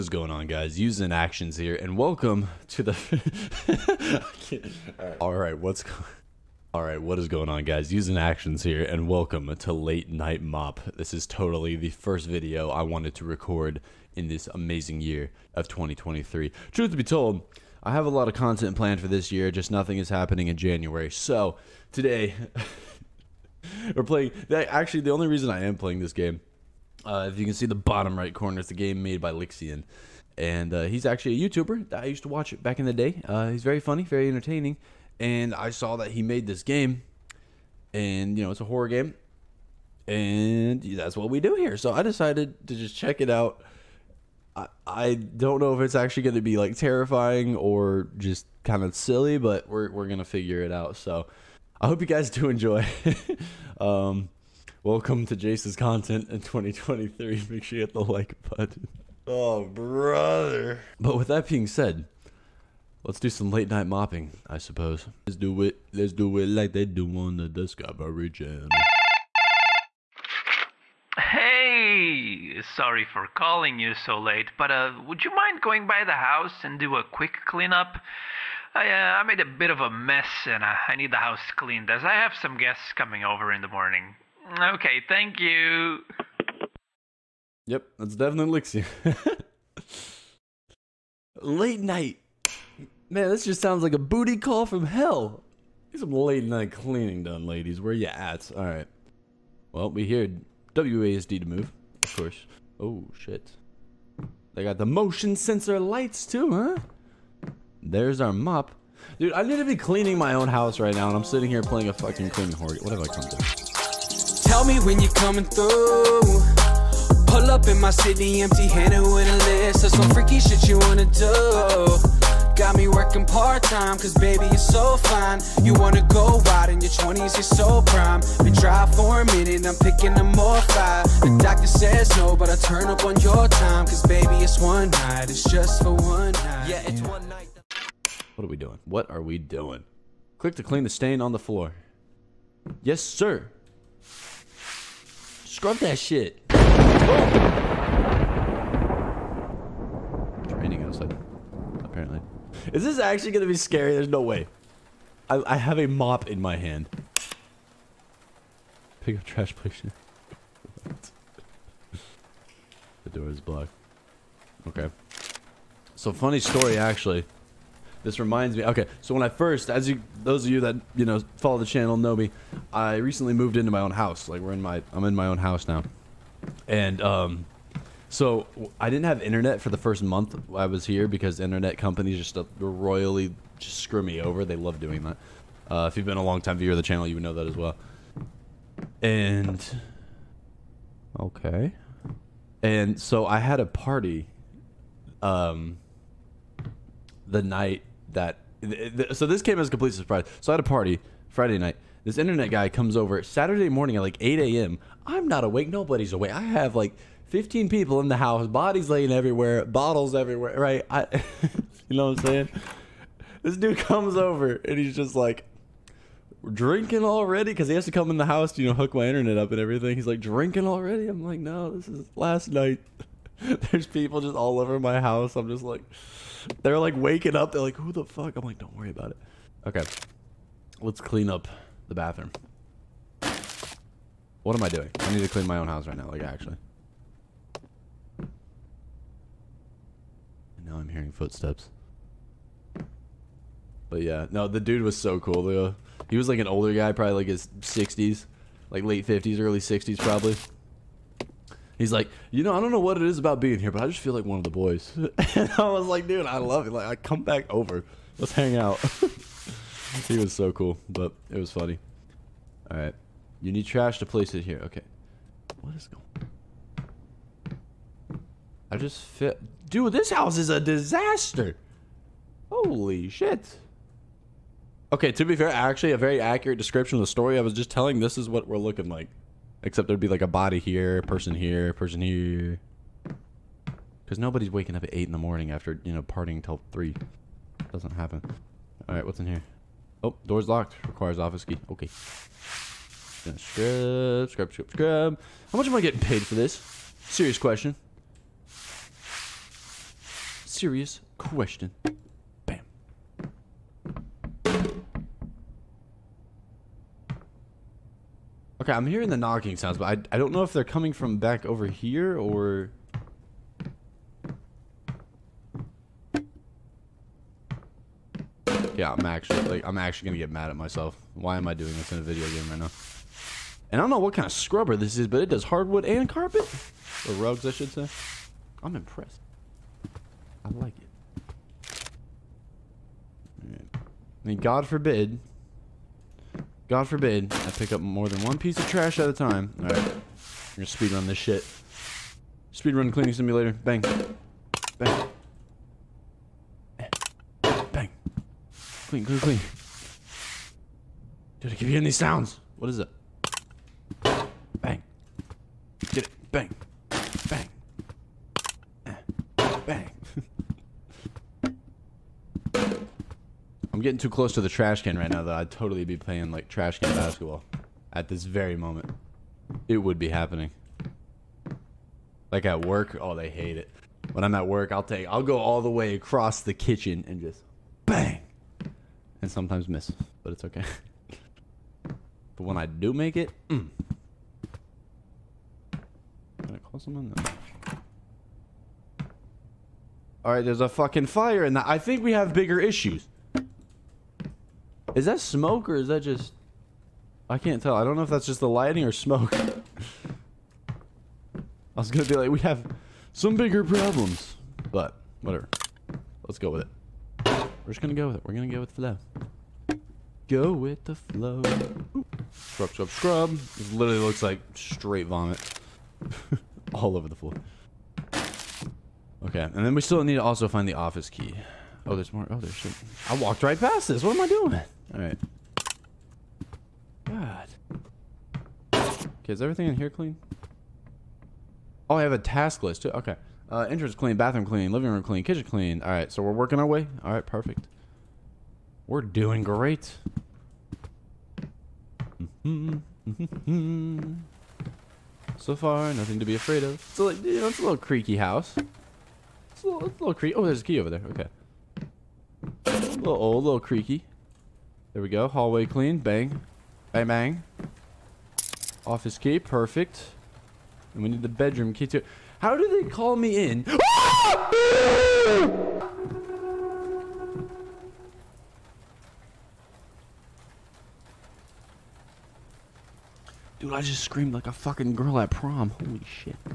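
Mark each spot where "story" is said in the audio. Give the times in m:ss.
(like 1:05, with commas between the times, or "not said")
2:46, 4:37.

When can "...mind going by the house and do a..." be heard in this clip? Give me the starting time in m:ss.
1:15.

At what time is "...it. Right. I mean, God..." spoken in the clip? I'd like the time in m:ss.
5:30.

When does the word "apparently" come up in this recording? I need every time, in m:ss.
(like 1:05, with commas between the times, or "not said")
2:31.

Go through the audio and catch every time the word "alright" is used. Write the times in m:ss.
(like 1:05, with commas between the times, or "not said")
4:48, 5:39.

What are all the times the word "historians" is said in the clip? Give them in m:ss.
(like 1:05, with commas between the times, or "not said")
not said.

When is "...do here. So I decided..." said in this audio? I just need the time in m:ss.
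0:41.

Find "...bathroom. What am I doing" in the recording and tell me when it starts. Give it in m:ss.
3:51.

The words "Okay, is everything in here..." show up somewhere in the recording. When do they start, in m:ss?
7:08.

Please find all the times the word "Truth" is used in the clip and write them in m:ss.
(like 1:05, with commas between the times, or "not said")
0:16.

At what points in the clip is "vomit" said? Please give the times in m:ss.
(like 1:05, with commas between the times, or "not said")
6:55.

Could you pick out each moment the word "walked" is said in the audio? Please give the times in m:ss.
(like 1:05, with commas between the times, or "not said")
7:03.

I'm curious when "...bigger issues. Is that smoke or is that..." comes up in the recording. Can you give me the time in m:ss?
6:32.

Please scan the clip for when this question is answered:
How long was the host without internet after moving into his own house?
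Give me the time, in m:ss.
2:59.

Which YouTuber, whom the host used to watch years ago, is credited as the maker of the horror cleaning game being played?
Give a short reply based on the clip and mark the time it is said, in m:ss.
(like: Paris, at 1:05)
Lixian, at 0:29.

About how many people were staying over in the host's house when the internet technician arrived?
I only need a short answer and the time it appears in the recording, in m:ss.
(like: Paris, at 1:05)
15, at 3:27.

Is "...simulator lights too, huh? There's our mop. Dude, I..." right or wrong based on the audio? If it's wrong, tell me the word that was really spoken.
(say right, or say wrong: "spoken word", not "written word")
wrong: "sensor", not "simulator".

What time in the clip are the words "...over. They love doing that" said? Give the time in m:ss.
3:04.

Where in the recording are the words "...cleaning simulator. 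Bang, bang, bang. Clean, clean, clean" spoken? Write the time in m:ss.
5:42.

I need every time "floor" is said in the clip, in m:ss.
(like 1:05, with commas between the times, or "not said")
2:21, 6:57.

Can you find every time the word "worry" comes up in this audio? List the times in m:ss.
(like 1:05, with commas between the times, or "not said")
3:48.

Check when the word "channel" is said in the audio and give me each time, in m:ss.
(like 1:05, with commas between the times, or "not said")
1:08, 2:51, 3:06.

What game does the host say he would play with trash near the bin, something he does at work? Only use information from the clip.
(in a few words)
trash can basketball.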